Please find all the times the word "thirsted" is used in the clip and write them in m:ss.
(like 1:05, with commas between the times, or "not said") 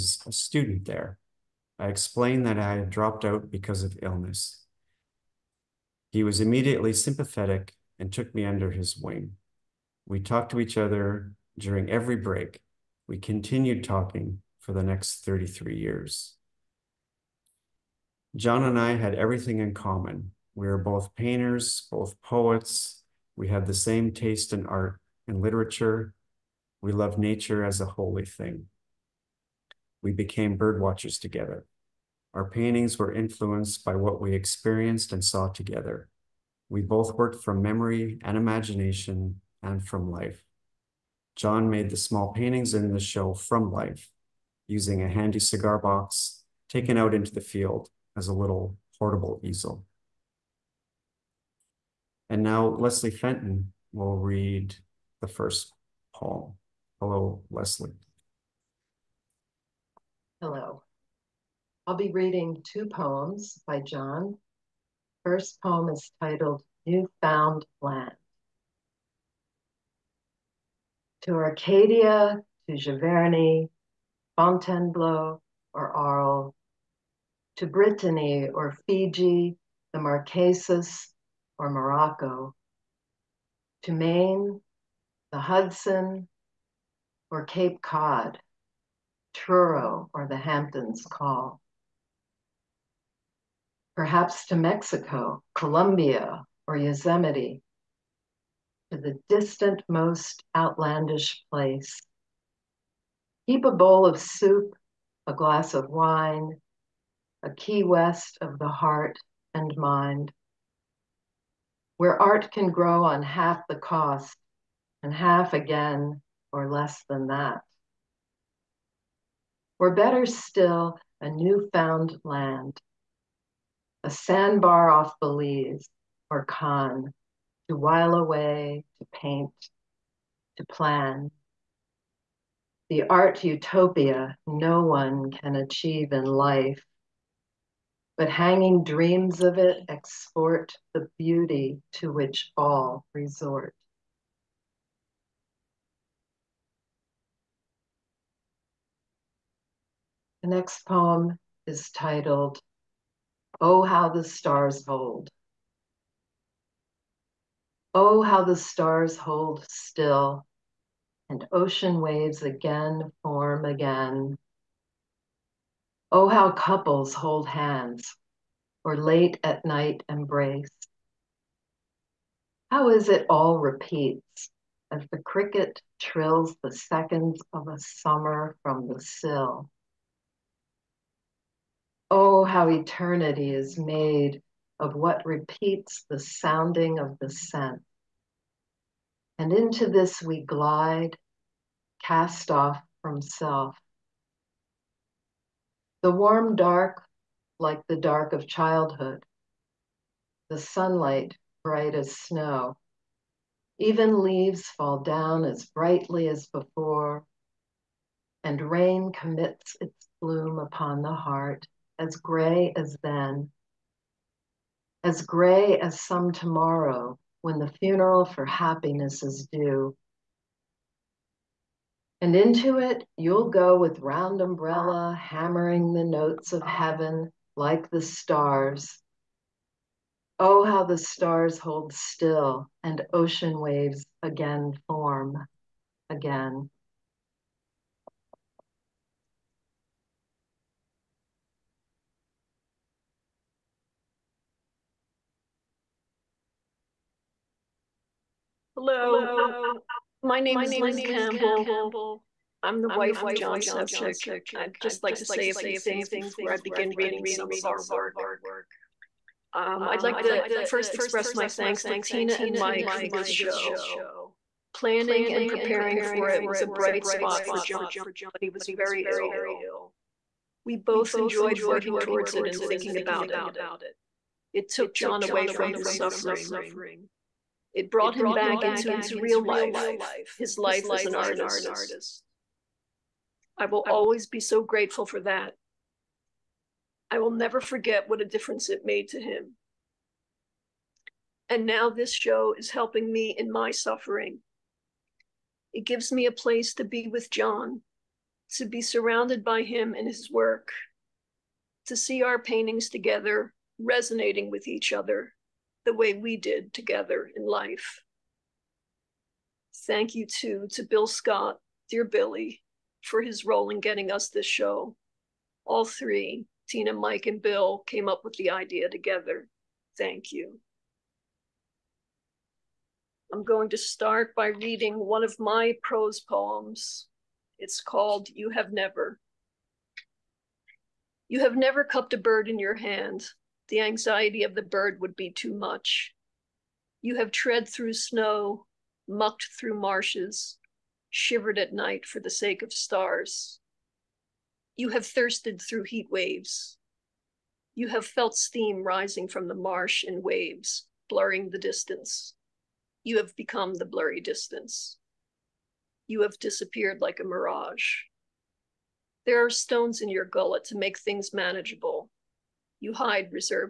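5:45.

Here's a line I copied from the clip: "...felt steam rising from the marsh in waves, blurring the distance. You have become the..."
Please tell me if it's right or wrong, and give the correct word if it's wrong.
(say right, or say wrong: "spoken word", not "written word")
right.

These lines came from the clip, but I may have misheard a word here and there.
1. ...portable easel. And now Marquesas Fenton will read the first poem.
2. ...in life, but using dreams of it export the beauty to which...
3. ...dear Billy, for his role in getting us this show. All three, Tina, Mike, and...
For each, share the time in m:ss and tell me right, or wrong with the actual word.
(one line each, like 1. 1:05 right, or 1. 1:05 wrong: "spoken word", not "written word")
1. 0:48 wrong: "Leslie", not "Marquesas"
2. 2:16 wrong: "hanging", not "using"
3. 5:11 right.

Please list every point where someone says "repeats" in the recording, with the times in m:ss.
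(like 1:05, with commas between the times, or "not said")
2:53, 3:05.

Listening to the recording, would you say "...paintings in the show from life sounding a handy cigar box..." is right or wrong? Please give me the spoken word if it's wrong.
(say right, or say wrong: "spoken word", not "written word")
wrong: "using", not "sounding".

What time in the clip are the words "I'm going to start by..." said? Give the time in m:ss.
5:23.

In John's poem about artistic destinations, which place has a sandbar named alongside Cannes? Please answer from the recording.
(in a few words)
Belize.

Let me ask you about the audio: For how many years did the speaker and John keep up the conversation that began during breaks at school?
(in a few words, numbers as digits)
33.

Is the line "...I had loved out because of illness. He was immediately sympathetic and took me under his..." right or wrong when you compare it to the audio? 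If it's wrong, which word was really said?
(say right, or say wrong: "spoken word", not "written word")
wrong: "dropped", not "loved".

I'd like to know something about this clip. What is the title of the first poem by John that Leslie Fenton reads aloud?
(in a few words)
New Found Land.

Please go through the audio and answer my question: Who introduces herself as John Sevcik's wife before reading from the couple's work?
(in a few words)
Lynne Campbell.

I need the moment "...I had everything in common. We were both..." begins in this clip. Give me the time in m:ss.
0:18.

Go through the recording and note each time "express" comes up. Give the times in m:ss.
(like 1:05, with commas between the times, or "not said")
4:20.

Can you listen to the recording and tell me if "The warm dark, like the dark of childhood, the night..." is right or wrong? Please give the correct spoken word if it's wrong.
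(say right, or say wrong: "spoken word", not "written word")
wrong: "sunlight", not "night".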